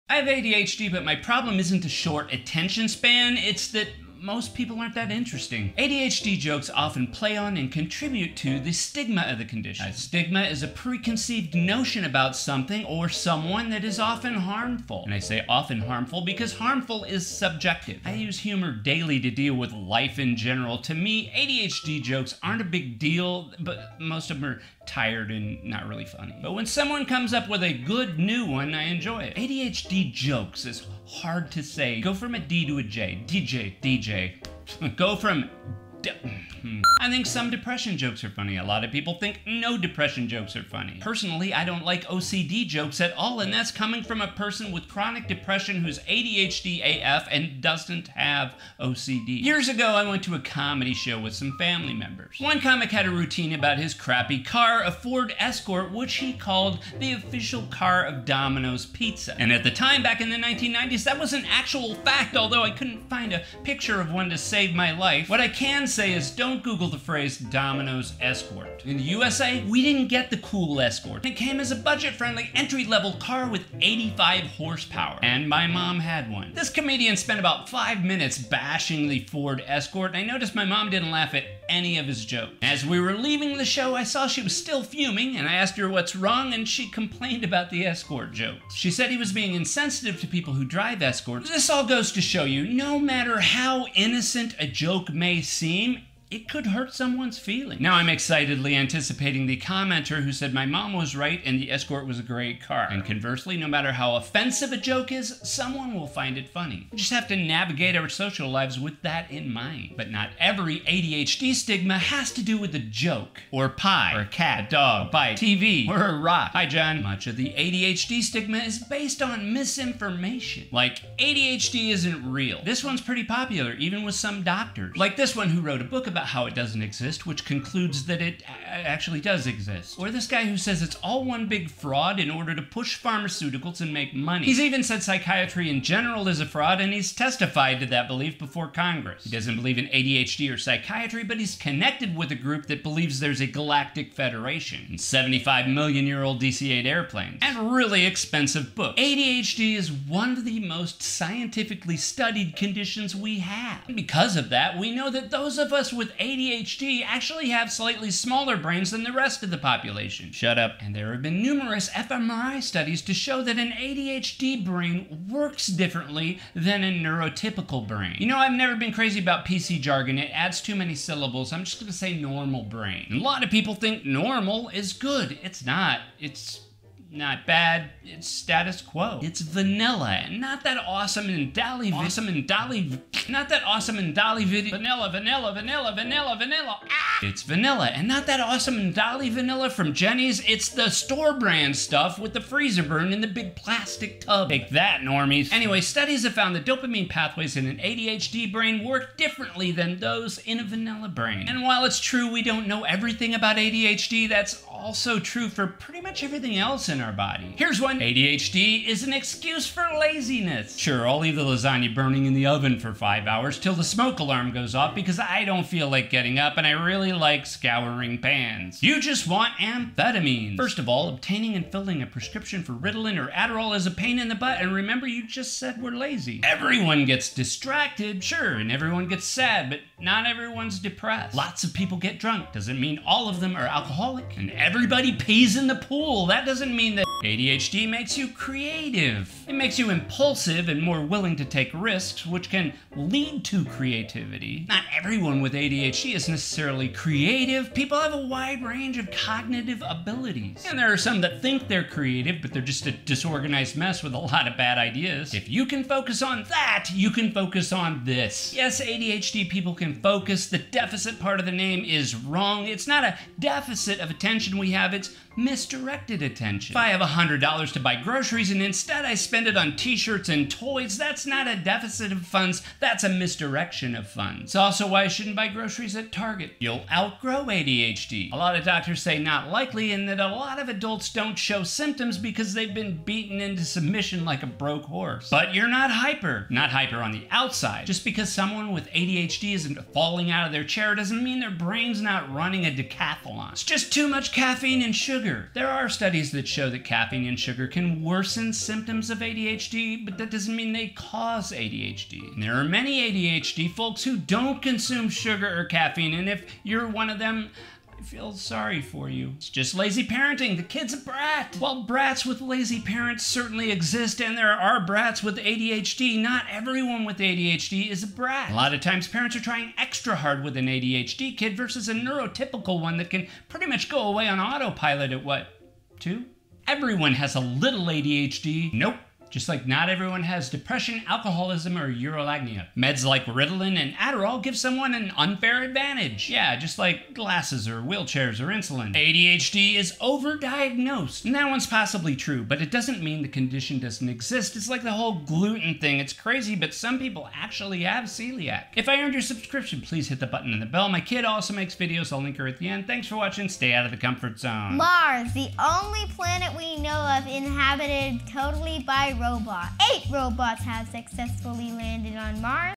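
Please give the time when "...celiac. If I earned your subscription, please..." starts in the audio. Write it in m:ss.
5:48.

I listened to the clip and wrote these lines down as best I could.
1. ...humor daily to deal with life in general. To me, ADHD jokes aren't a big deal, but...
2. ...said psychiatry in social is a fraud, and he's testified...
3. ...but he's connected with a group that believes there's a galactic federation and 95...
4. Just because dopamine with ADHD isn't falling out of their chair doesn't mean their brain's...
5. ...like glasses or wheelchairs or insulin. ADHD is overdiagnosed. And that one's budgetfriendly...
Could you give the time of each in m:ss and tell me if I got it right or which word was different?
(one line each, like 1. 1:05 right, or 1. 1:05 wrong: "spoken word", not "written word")
1. 0:18 right
2. 2:14 wrong: "general", not "social"
3. 2:21 wrong: "75", not "95"
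4. 4:47 wrong: "someone", not "dopamine"
5. 5:36 wrong: "possibly", not "budgetfriendly".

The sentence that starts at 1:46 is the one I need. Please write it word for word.
We just have to navigate our social lives with that in mind.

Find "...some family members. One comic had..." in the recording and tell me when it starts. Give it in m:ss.
0:51.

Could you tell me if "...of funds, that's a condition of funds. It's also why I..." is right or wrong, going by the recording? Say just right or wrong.
wrong.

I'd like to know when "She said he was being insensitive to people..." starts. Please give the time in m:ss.
1:28.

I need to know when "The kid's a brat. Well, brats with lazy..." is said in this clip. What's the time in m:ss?
5:10.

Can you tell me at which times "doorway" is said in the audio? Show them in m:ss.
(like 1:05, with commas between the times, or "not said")
not said.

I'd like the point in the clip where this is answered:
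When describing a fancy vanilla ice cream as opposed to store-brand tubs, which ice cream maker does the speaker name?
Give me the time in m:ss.
3:09.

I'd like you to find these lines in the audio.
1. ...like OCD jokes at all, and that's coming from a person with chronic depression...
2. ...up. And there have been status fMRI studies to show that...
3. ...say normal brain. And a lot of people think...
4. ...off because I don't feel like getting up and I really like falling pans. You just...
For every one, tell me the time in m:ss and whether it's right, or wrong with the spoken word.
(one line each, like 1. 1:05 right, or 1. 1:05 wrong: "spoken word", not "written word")
1. 0:41 right
2. 2:40 wrong: "numerous", not "status"
3. 2:51 right
4. 3:34 wrong: "scouring", not "falling".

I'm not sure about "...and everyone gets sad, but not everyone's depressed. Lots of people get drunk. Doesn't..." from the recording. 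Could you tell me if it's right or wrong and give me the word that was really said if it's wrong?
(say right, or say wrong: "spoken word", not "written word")
right.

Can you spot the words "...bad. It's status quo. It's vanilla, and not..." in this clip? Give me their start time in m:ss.
2:57.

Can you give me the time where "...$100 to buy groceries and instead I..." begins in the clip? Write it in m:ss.
4:27.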